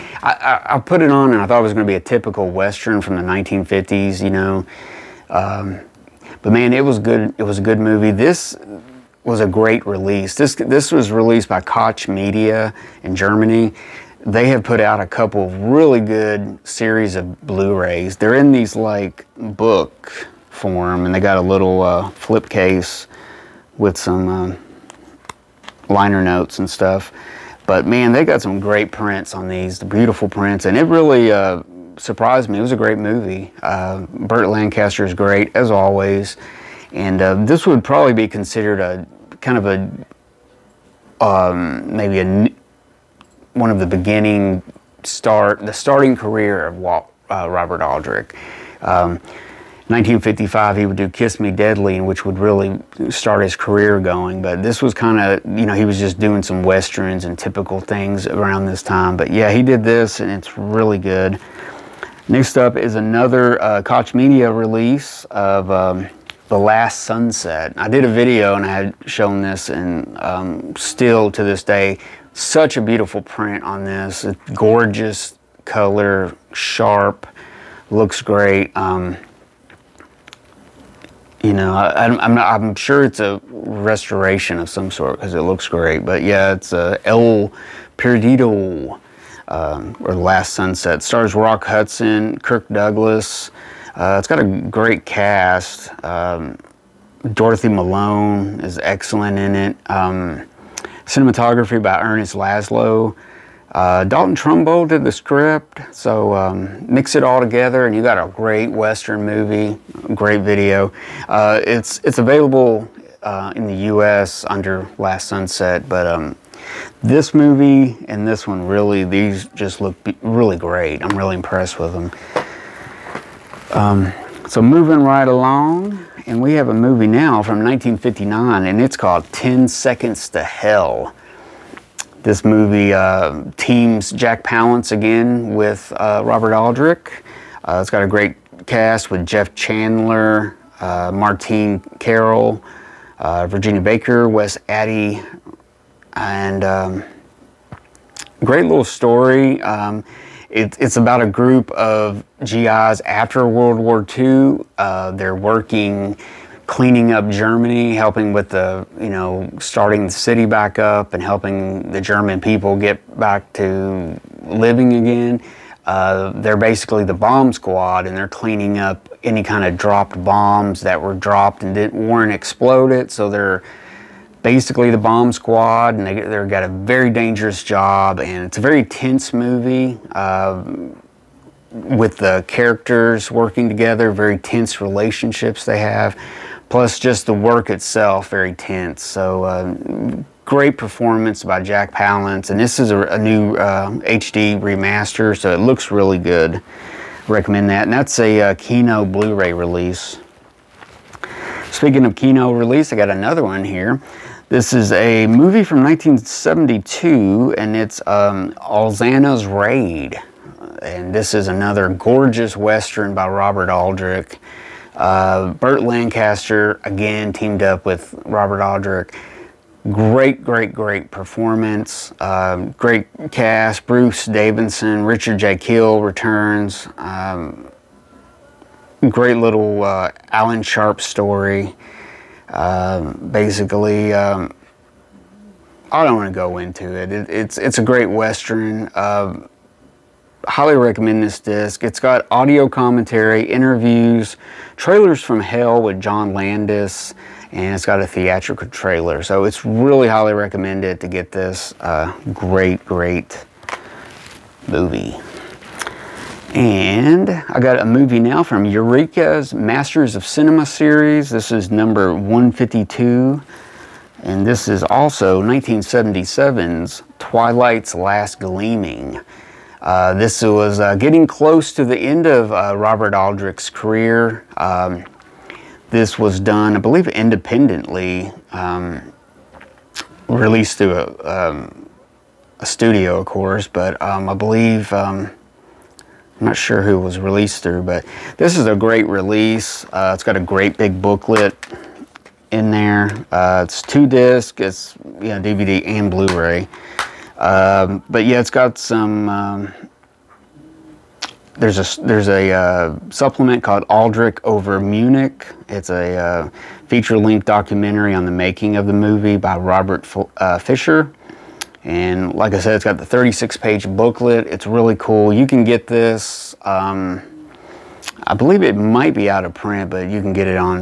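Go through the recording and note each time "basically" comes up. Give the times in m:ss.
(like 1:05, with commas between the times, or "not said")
2:46, 2:54, 3:53.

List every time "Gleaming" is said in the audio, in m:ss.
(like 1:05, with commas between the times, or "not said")
4:28.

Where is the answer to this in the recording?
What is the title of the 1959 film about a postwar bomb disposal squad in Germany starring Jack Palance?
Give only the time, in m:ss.
2:09.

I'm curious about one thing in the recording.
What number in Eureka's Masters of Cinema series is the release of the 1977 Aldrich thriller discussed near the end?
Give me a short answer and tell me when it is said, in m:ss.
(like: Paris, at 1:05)
152, at 4:22.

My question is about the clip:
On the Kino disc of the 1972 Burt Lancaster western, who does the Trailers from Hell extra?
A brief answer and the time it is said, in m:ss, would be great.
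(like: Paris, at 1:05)
John Landis, at 4:05.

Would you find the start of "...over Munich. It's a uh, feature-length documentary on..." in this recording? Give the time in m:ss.
5:04.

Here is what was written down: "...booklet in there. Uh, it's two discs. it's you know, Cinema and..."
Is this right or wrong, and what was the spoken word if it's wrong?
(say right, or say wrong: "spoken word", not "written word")
wrong: "DVD", not "Cinema".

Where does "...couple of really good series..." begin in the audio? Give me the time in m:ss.
0:15.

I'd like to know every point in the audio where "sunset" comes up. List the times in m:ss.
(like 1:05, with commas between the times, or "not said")
1:07, 1:30, 1:55.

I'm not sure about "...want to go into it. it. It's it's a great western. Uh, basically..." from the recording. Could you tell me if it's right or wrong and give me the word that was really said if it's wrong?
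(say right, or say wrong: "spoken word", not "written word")
wrong: "highly", not "basically".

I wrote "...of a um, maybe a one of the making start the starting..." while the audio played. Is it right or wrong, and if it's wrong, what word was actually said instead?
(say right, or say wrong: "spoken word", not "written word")
wrong: "beginning", not "making".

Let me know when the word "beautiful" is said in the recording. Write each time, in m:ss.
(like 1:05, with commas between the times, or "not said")
0:29, 1:12.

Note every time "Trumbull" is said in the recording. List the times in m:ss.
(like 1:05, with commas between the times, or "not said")
1:44.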